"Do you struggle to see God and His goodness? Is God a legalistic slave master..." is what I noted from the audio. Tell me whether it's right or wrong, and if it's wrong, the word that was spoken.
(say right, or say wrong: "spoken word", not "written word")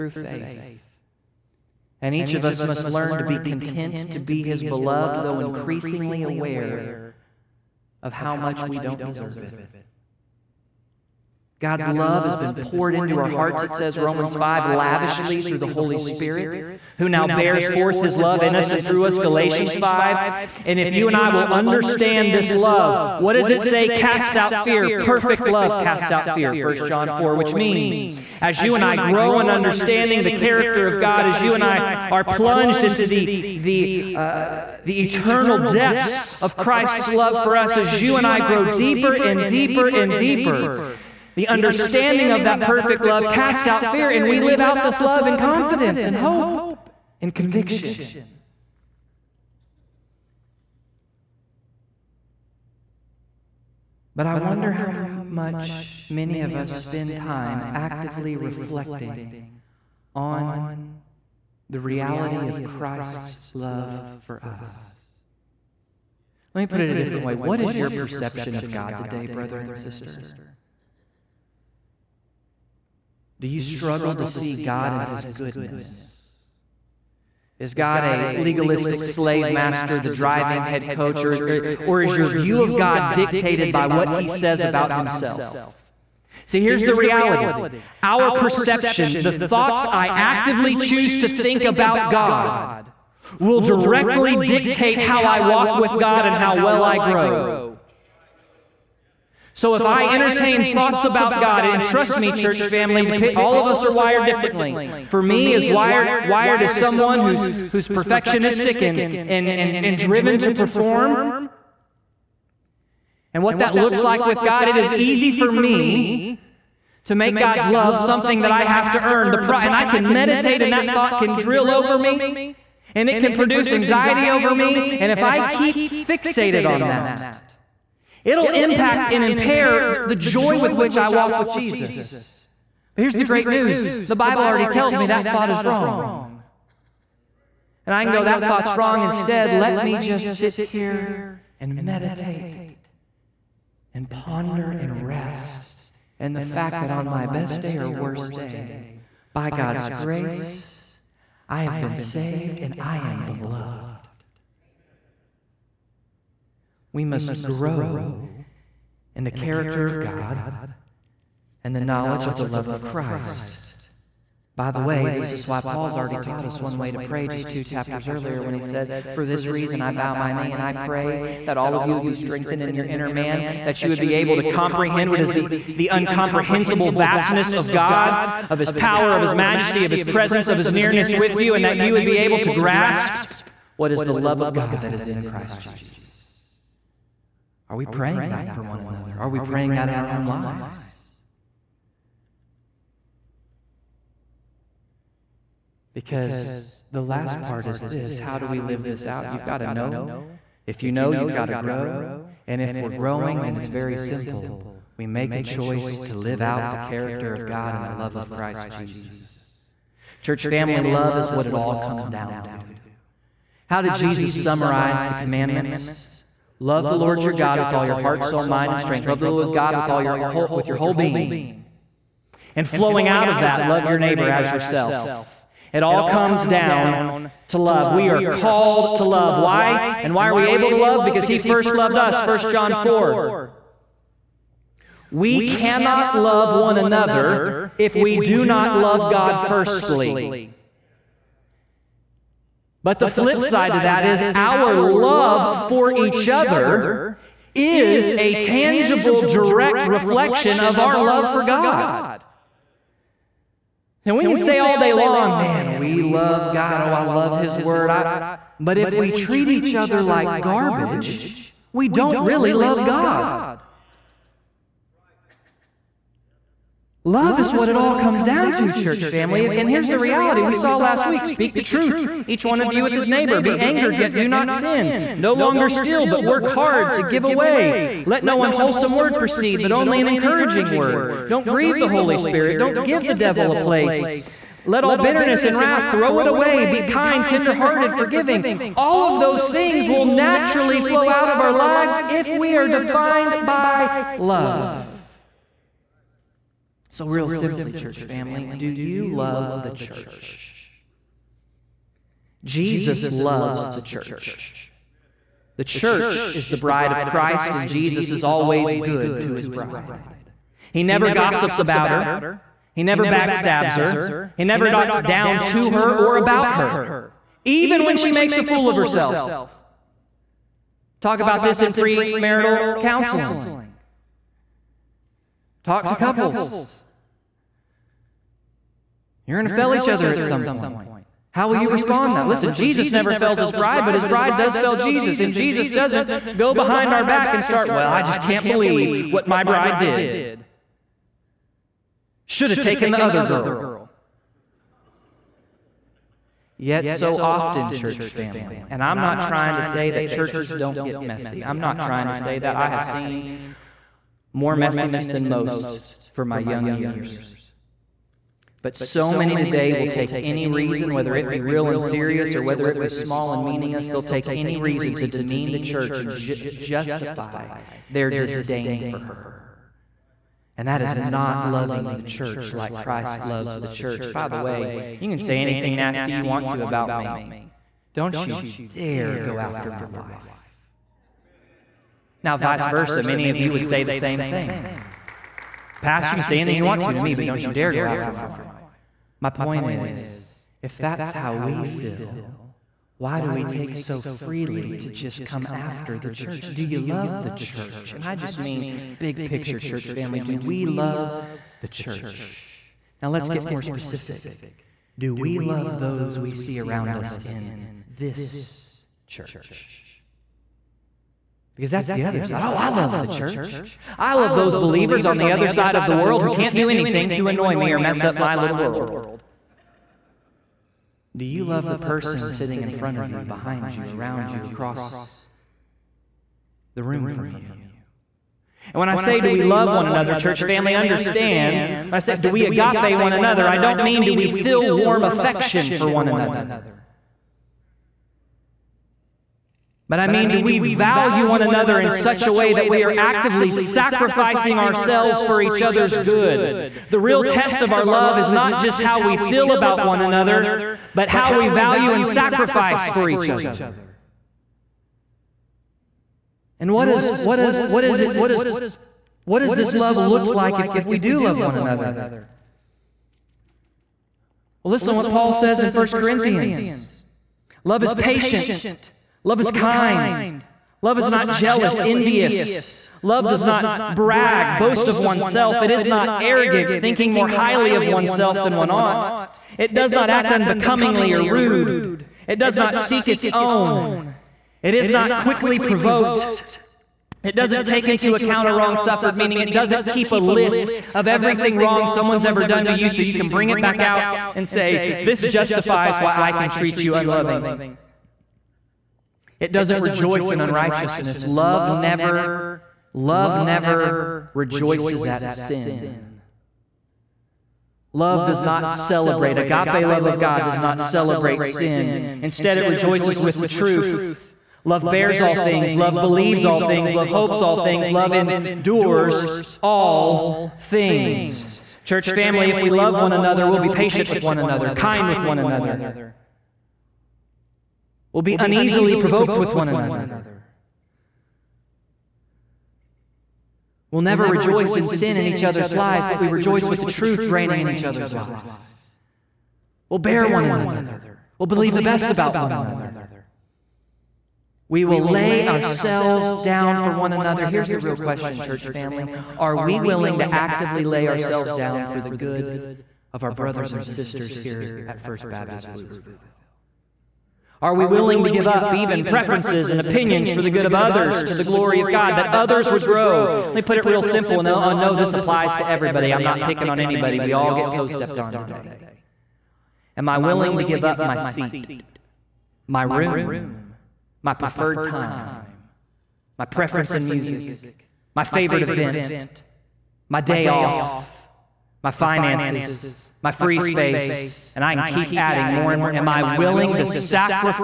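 right.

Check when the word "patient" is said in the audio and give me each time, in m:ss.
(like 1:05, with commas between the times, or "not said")
7:47, 8:43.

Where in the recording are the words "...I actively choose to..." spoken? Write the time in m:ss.
1:29.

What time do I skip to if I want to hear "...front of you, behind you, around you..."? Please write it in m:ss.
7:02.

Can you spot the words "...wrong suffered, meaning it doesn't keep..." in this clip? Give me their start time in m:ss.
8:08.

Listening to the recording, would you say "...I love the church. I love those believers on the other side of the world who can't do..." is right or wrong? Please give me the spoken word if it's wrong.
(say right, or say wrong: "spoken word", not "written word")
right.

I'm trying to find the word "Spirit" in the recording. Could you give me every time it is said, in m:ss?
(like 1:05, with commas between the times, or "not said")
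0:15, 4:42.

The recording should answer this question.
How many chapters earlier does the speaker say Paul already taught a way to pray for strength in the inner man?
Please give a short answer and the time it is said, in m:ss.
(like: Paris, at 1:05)
2, at 2:47.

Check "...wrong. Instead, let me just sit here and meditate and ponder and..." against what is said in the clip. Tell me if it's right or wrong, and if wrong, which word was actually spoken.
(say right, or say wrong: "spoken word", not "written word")
right.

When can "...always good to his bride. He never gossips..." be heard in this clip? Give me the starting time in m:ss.
5:08.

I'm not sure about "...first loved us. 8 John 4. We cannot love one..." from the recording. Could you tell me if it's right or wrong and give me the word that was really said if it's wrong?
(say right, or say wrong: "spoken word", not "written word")
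wrong: "1", not "8".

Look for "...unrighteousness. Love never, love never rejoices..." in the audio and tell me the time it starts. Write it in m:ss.
8:20.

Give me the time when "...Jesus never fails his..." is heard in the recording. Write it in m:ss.
5:32.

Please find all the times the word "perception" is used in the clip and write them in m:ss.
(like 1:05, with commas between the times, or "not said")
1:07, 1:28.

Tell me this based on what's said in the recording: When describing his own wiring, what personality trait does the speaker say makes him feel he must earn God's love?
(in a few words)
perfectionistic.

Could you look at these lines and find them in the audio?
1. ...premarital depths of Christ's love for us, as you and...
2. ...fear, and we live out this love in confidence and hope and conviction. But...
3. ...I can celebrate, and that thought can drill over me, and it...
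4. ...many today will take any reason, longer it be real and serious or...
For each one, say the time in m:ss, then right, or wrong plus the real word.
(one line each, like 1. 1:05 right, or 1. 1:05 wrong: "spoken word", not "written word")
1. 0:35 wrong: "eternal", not "premarital"
2. 0:43 right
3. 1:59 wrong: "meditate", not "celebrate"
4. 5:59 wrong: "whether", not "longer".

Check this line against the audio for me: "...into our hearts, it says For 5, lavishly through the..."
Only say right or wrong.
wrong.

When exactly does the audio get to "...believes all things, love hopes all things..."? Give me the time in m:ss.
8:35.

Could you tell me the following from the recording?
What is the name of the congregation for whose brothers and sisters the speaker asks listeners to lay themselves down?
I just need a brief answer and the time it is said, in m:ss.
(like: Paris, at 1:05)
First Baptist Pflugerville, at 9:15.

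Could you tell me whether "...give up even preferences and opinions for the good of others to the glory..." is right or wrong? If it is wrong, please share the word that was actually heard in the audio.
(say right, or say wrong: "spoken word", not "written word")
right.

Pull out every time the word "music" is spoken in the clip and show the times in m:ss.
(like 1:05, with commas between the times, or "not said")
9:37.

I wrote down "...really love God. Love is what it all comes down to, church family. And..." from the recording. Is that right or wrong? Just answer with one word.
right.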